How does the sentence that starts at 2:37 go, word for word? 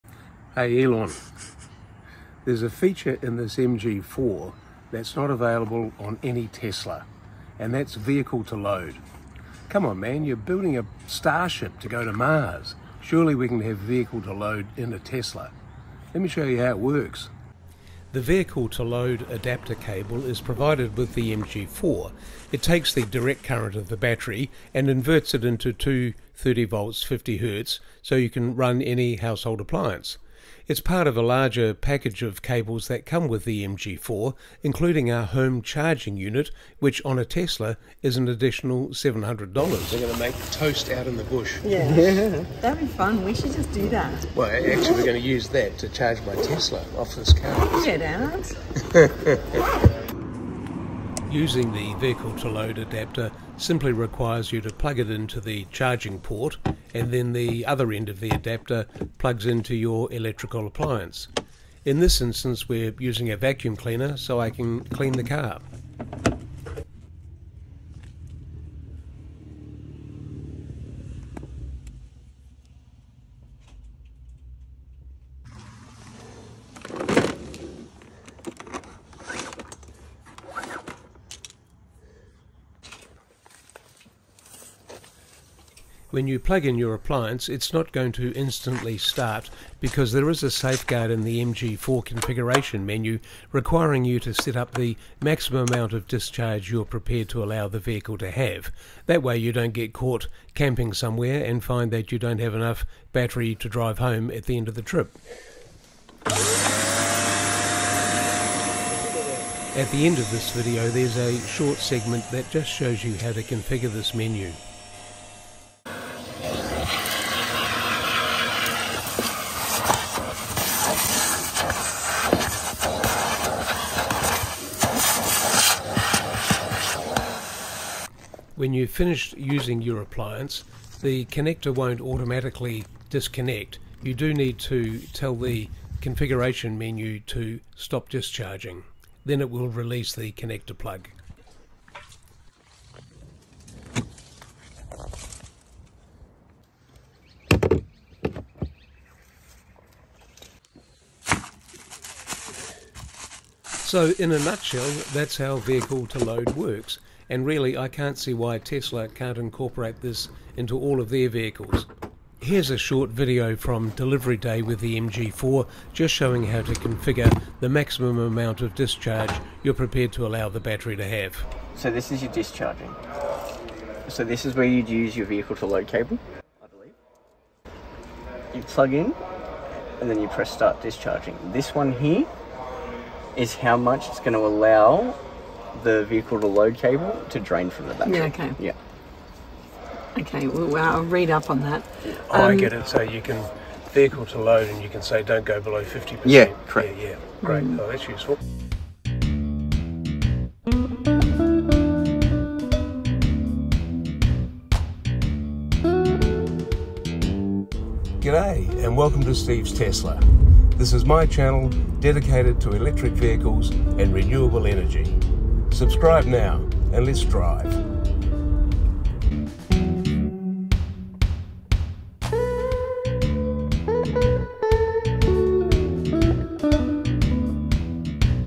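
And really, I can't see why Tesla can't incorporate this into all of their vehicles.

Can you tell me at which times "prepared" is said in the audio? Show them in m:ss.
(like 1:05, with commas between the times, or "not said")
1:36, 2:49.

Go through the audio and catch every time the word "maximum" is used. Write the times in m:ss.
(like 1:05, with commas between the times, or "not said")
1:35, 2:47.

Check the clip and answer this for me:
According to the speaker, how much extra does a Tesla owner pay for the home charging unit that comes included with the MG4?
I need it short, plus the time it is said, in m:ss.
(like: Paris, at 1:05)
$700, at 0:38.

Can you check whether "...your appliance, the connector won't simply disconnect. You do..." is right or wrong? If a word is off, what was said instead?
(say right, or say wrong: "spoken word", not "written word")
wrong: "automatically", not "simply".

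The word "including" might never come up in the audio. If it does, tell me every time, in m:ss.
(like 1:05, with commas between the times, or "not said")
0:34.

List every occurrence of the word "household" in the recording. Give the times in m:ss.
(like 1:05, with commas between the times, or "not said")
0:29.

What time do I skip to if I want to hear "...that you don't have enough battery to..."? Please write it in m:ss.
1:41.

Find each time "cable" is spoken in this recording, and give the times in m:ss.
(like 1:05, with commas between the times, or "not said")
0:19, 0:32, 2:55, 3:06.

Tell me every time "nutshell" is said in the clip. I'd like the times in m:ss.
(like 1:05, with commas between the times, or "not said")
2:34.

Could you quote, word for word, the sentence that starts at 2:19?
Then it will release the connector plug.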